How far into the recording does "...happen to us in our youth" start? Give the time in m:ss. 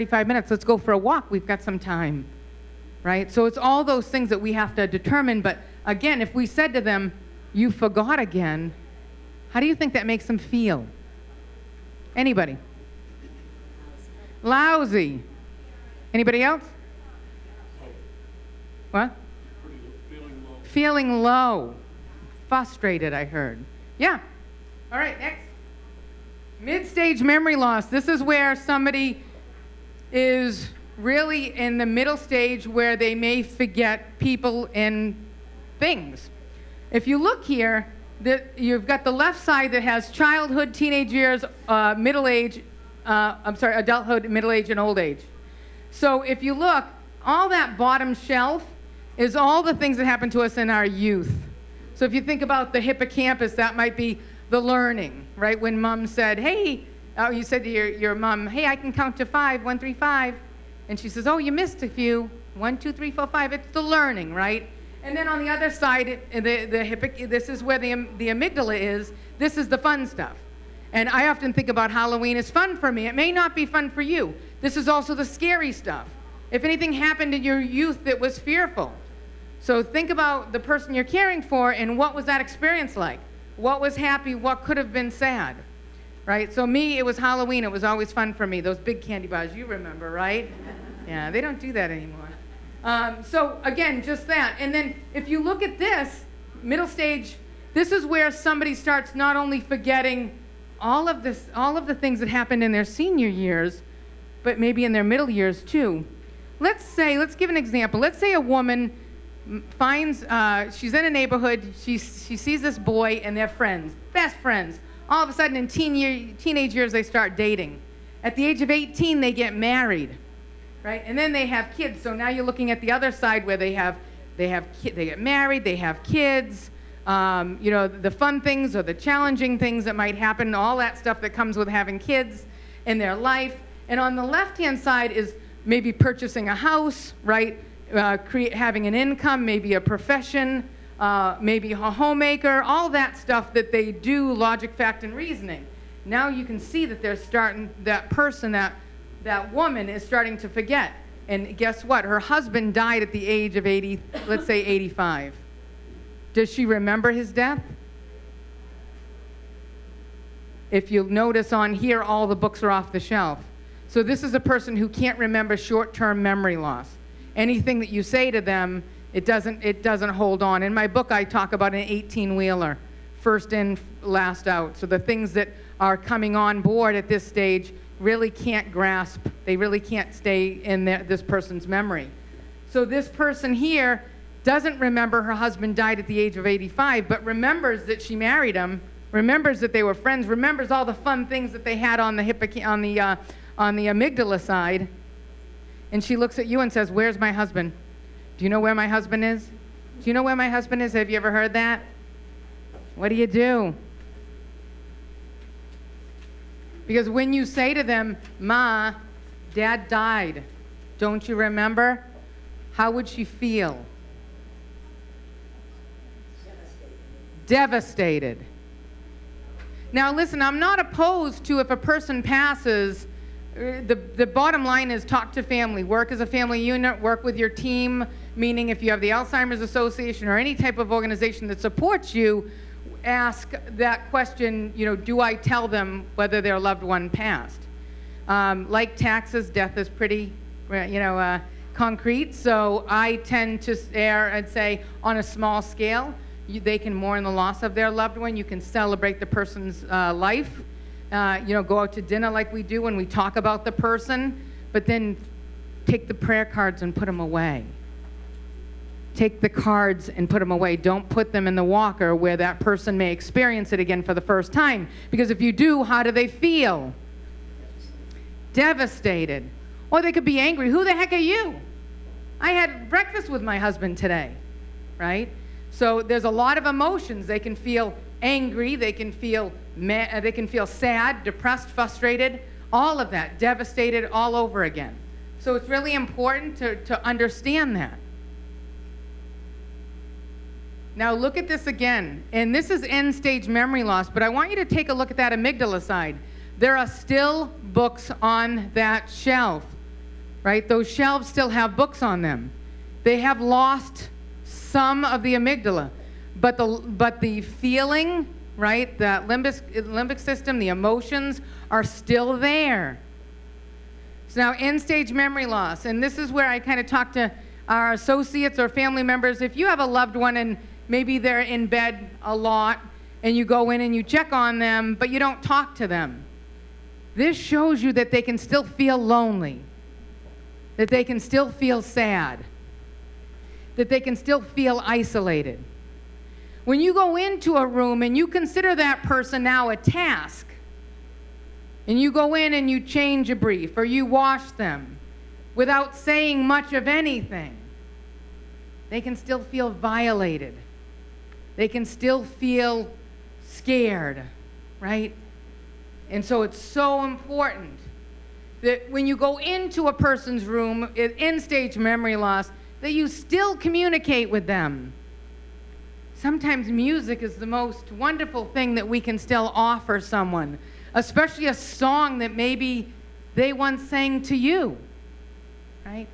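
0:50.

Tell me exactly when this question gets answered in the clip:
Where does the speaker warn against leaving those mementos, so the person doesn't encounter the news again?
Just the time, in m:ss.
4:21.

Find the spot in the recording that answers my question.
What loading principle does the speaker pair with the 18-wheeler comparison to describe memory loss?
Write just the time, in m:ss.
2:53.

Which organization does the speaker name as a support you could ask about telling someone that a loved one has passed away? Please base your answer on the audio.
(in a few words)
Alzheimer's Association.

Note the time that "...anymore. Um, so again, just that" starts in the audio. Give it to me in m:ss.
1:31.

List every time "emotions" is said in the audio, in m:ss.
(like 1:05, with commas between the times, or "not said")
4:36, 5:10.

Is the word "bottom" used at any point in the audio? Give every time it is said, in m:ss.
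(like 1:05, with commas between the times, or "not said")
0:47, 3:44.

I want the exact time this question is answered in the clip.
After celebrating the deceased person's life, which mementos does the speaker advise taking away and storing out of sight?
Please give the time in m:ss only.
4:16.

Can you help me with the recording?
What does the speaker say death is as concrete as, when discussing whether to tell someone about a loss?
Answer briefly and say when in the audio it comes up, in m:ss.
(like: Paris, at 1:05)
taxes, at 3:58.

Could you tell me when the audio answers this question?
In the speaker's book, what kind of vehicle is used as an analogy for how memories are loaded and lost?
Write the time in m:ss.
2:51.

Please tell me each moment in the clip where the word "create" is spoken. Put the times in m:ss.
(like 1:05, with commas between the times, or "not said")
2:18.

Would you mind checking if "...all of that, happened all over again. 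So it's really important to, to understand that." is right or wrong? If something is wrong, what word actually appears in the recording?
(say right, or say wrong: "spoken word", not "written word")
wrong: "devastated", not "happened".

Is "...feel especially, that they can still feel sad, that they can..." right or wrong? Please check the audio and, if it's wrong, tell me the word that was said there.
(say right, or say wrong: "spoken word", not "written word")
wrong: "lonely", not "especially".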